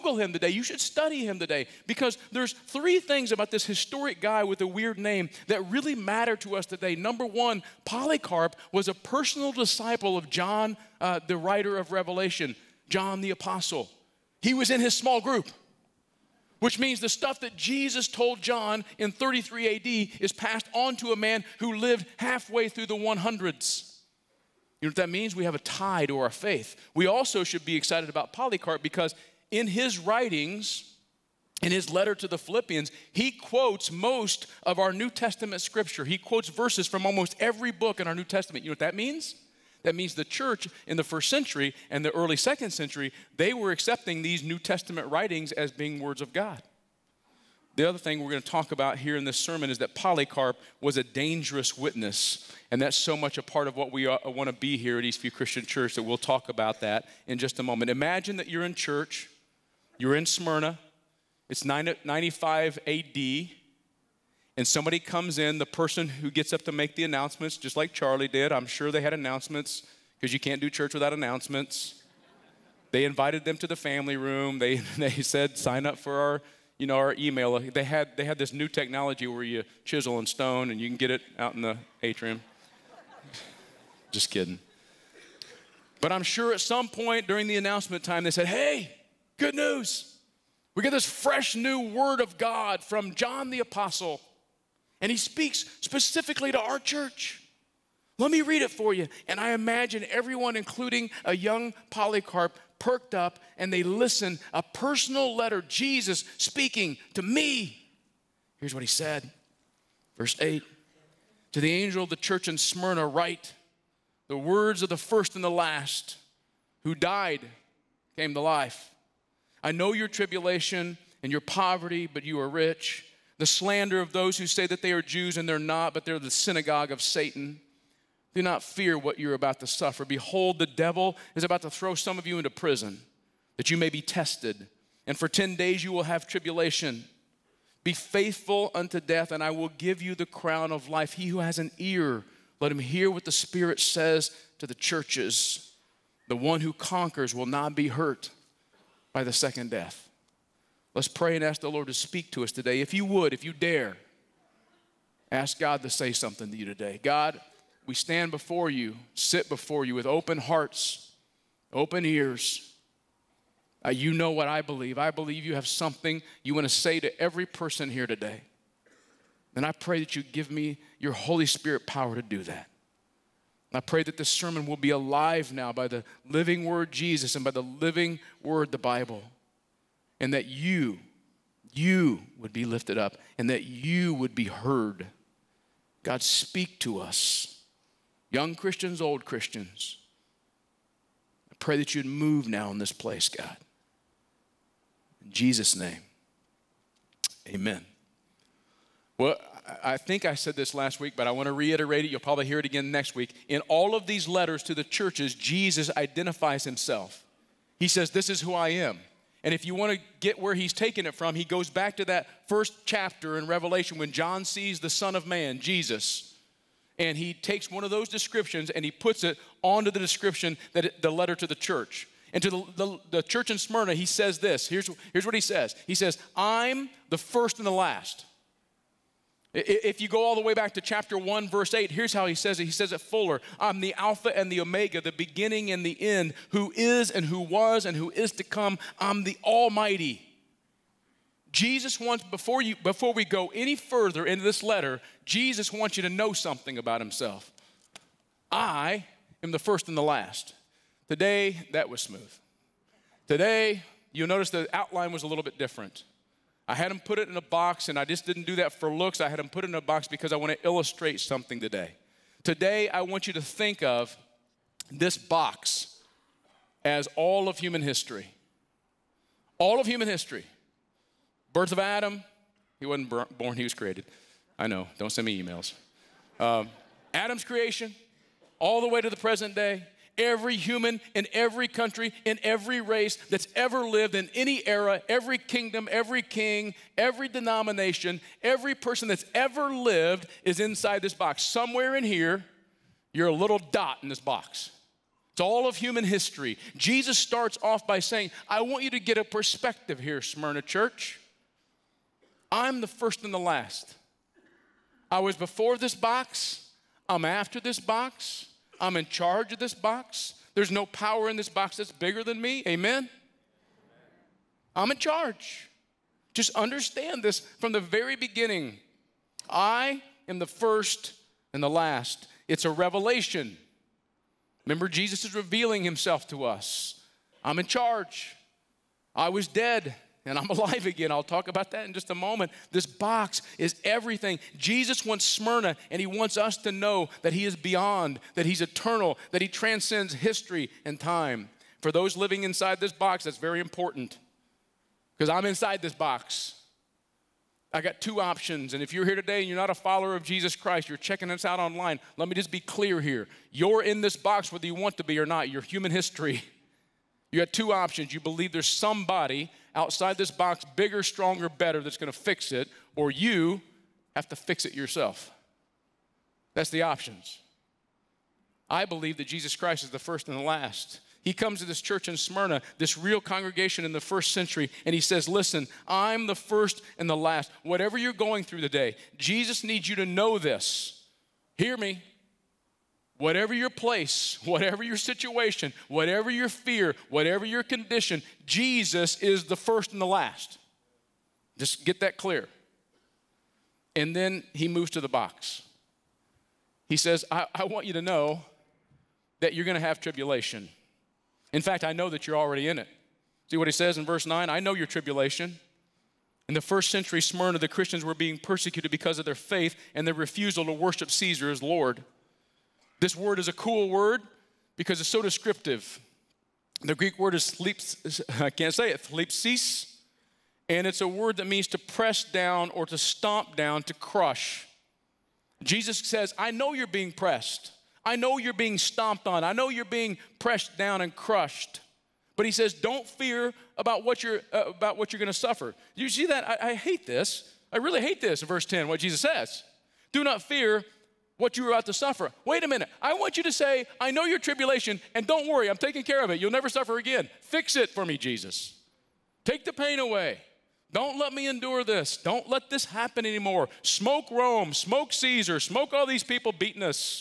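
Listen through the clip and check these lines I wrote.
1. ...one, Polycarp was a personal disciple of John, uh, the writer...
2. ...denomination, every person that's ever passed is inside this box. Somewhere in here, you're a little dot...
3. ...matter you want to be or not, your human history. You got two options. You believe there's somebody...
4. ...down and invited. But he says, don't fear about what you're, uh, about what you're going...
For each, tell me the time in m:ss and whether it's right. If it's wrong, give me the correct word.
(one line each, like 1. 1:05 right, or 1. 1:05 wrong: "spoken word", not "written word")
1. 0:07 right
2. 4:47 wrong: "lived", not "passed"
3. 5:54 wrong: "whether", not "matter"
4. 7:10 wrong: "crushed", not "invited".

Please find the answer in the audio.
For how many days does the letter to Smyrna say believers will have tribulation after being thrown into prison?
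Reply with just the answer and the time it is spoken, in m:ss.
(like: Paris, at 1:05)
10, at 2:15.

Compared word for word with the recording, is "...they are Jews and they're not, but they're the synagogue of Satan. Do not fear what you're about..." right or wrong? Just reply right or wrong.
right.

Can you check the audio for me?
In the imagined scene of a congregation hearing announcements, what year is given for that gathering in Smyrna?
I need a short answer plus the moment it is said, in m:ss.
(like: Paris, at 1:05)
95 AD, at 1:01.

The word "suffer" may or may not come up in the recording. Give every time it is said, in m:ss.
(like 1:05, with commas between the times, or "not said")
2:09, 7:15, 7:21, 7:26.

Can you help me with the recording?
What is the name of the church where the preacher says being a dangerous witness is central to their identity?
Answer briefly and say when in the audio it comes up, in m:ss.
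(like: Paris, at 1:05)
Eastview Christian Church, at 0:55.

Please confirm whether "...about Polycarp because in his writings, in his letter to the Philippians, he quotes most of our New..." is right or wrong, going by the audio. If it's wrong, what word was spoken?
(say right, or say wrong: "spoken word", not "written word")
right.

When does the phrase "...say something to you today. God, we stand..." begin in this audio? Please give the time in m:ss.
2:35.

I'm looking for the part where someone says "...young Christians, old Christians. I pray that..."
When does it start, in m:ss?
3:08.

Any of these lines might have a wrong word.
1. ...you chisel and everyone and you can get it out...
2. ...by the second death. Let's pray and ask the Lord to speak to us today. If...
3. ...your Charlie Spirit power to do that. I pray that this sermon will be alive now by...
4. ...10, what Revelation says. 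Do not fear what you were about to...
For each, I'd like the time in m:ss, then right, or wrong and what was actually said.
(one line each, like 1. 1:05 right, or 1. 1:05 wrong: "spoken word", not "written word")
1. 1:19 wrong: "stone", not "everyone"
2. 2:29 right
3. 2:50 wrong: "Holy", not "Charlie"
4. 7:18 wrong: "Jesus", not "Revelation".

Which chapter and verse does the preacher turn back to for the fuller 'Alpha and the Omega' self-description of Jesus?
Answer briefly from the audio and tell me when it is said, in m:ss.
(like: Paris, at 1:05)
Chapter 1, verse 8, at 3:50.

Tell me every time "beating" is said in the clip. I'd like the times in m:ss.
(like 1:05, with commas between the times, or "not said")
7:36.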